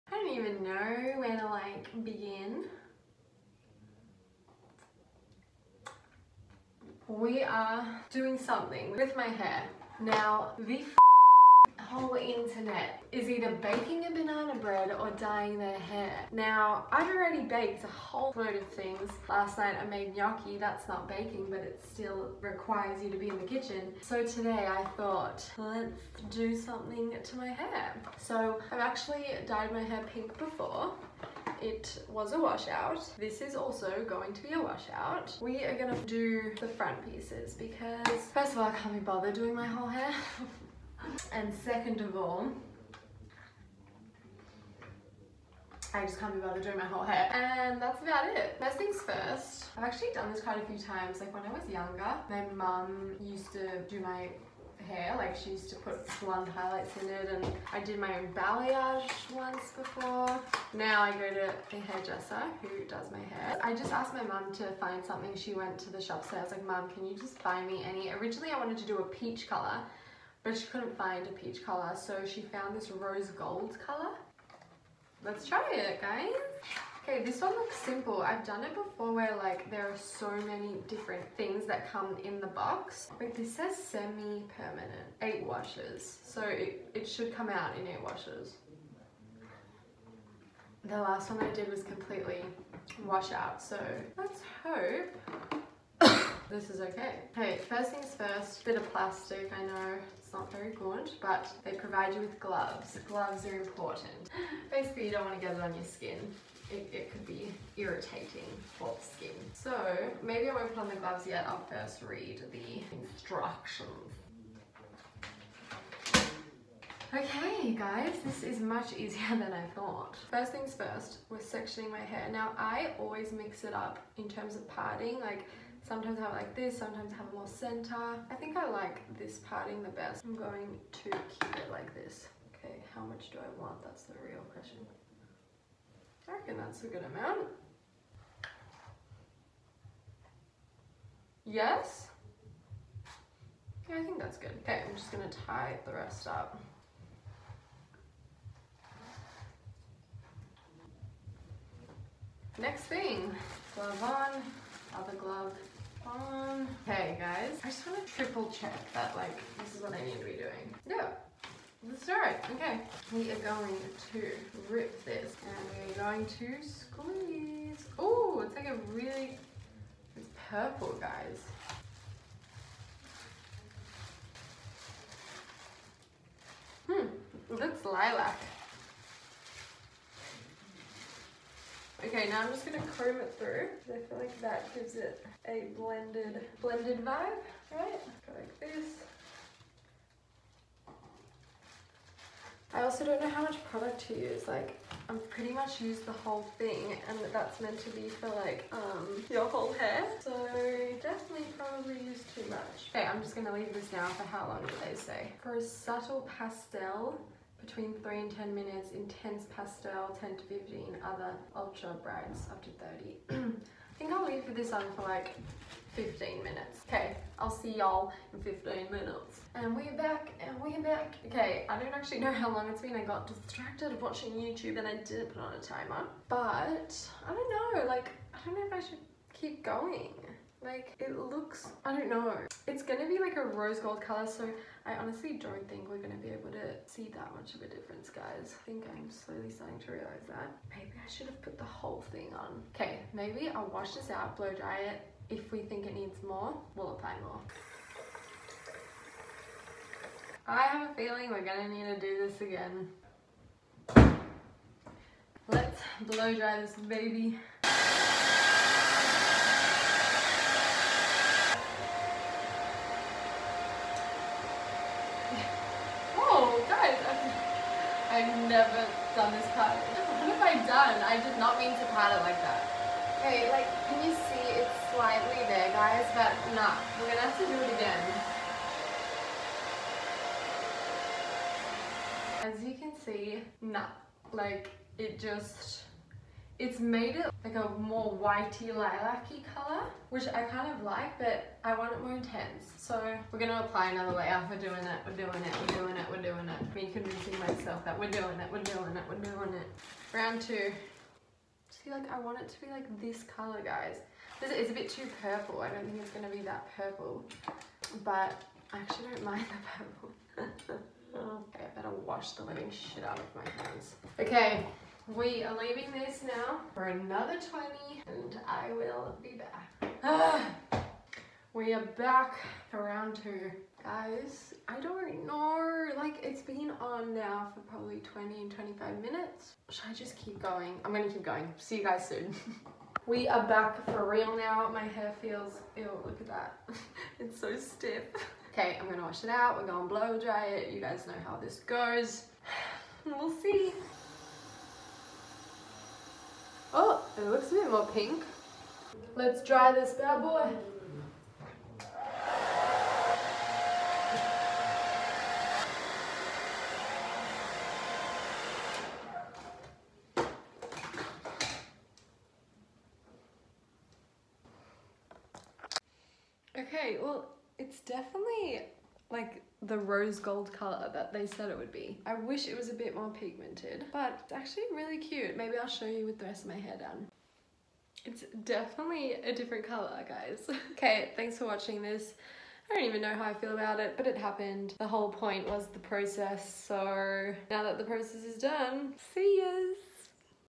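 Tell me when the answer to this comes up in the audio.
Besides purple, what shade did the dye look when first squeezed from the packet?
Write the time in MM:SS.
02:57.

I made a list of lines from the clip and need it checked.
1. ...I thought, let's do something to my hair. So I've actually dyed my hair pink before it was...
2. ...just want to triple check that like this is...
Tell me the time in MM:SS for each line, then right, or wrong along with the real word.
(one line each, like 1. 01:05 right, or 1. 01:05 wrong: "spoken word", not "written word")
1. 00:24 right
2. 02:37 right.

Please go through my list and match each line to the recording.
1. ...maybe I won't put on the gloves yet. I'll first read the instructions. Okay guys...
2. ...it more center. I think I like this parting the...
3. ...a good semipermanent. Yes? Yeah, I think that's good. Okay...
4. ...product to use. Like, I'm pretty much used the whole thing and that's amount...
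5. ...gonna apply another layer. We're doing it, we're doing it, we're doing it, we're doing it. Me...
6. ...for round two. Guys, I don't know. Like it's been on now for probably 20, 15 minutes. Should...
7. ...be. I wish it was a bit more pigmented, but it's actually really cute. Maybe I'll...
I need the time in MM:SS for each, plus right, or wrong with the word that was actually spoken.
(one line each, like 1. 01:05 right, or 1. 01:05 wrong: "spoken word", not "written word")
1. 01:50 right
2. 02:07 right
3. 02:16 wrong: "amount", not "semipermanent"
4. 03:13 wrong: "meant", not "amount"
5. 04:53 right
6. 05:22 wrong: "25", not "15"
7. 06:11 right.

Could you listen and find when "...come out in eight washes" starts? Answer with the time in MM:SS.
01:27.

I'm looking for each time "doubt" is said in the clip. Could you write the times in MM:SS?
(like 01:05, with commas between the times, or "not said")
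not said.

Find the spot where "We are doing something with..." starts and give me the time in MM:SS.
00:07.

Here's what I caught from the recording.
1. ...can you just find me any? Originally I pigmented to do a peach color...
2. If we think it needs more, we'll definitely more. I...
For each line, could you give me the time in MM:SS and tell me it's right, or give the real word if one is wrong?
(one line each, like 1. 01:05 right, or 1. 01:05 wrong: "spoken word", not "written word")
1. 01:06 wrong: "wanted", not "pigmented"
2. 04:05 wrong: "apply", not "definitely".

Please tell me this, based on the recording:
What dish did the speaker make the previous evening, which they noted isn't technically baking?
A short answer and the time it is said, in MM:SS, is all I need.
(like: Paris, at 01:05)
Gnocchi, at 00:20.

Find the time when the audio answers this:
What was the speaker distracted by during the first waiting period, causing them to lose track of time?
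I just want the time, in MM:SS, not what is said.
03:44.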